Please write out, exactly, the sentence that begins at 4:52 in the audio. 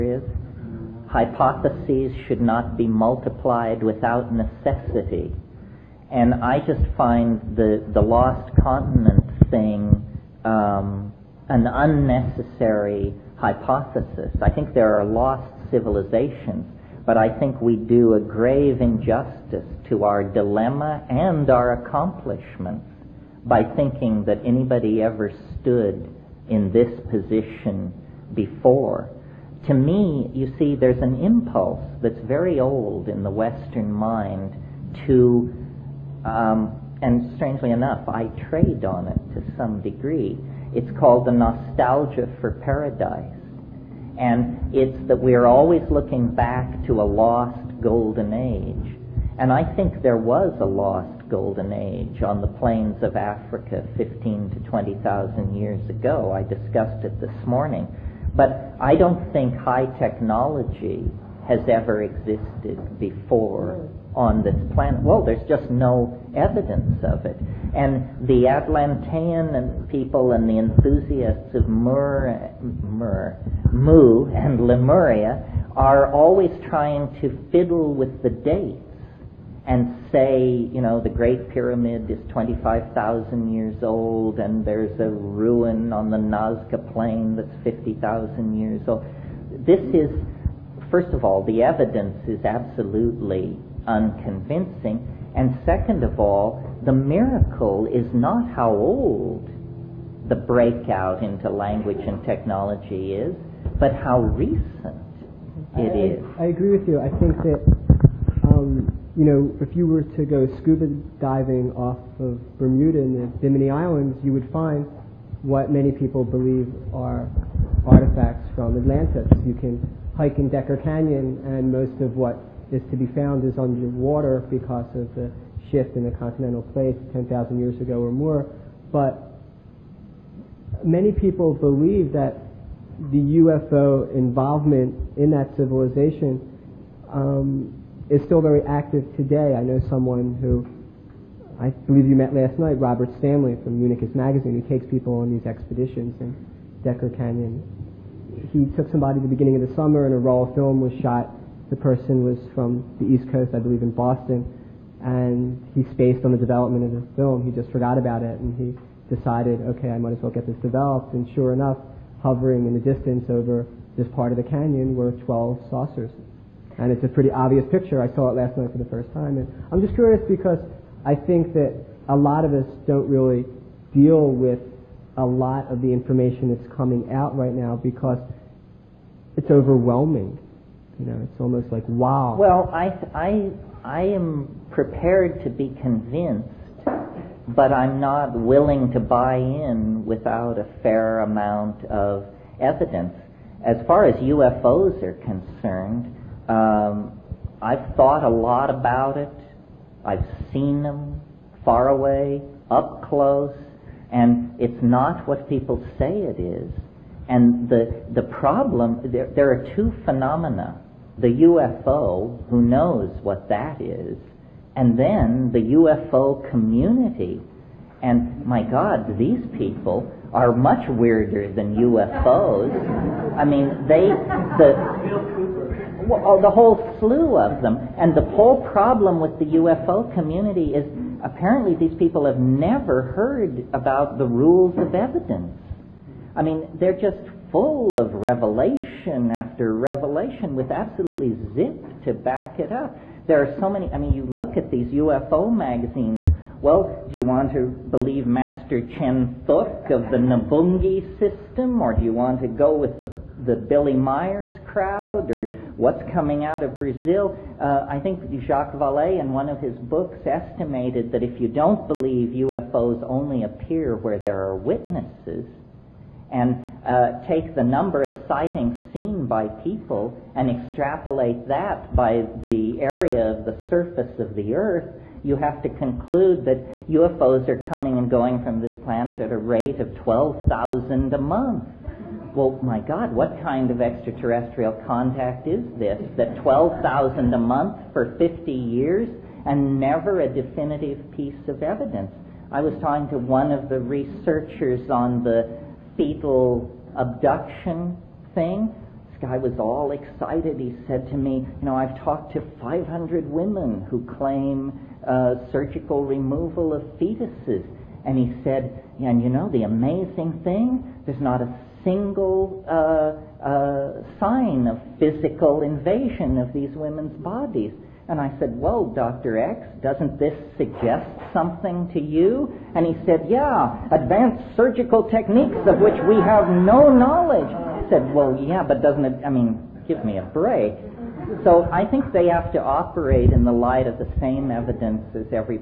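I was talking to one of the researchers on the fetal abduction thing.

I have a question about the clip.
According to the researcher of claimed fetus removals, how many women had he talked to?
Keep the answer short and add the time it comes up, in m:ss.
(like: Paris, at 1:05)
500, at 5:02.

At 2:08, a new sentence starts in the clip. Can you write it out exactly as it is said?
But many people believe that the UFO involvement in that civilization um, is still very active today.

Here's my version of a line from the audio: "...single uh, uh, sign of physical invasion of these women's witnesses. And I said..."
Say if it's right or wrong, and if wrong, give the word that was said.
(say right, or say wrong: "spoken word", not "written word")
wrong: "bodies", not "witnesses".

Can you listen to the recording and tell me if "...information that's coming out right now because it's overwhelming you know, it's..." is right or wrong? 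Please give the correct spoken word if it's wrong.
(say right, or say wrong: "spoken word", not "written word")
right.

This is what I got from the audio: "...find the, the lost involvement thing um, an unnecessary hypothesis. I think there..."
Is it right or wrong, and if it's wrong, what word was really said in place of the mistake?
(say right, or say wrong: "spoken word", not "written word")
wrong: "continent", not "involvement".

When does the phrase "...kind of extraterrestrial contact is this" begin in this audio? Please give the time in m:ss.
4:43.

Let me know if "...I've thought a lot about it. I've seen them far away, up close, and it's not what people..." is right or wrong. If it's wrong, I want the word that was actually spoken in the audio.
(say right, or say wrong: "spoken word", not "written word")
right.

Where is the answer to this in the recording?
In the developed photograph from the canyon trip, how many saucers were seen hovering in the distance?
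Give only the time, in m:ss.
2:45.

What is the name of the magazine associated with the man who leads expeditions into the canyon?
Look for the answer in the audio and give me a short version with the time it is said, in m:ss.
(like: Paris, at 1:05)
Unicus Magazine, at 2:23.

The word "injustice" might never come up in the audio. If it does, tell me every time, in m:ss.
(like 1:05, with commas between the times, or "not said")
0:18.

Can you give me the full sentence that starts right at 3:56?
I mean, they're just full of revelation after revelation with absolutely zip to back it up.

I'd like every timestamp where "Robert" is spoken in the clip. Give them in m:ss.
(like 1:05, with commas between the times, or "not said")
2:22.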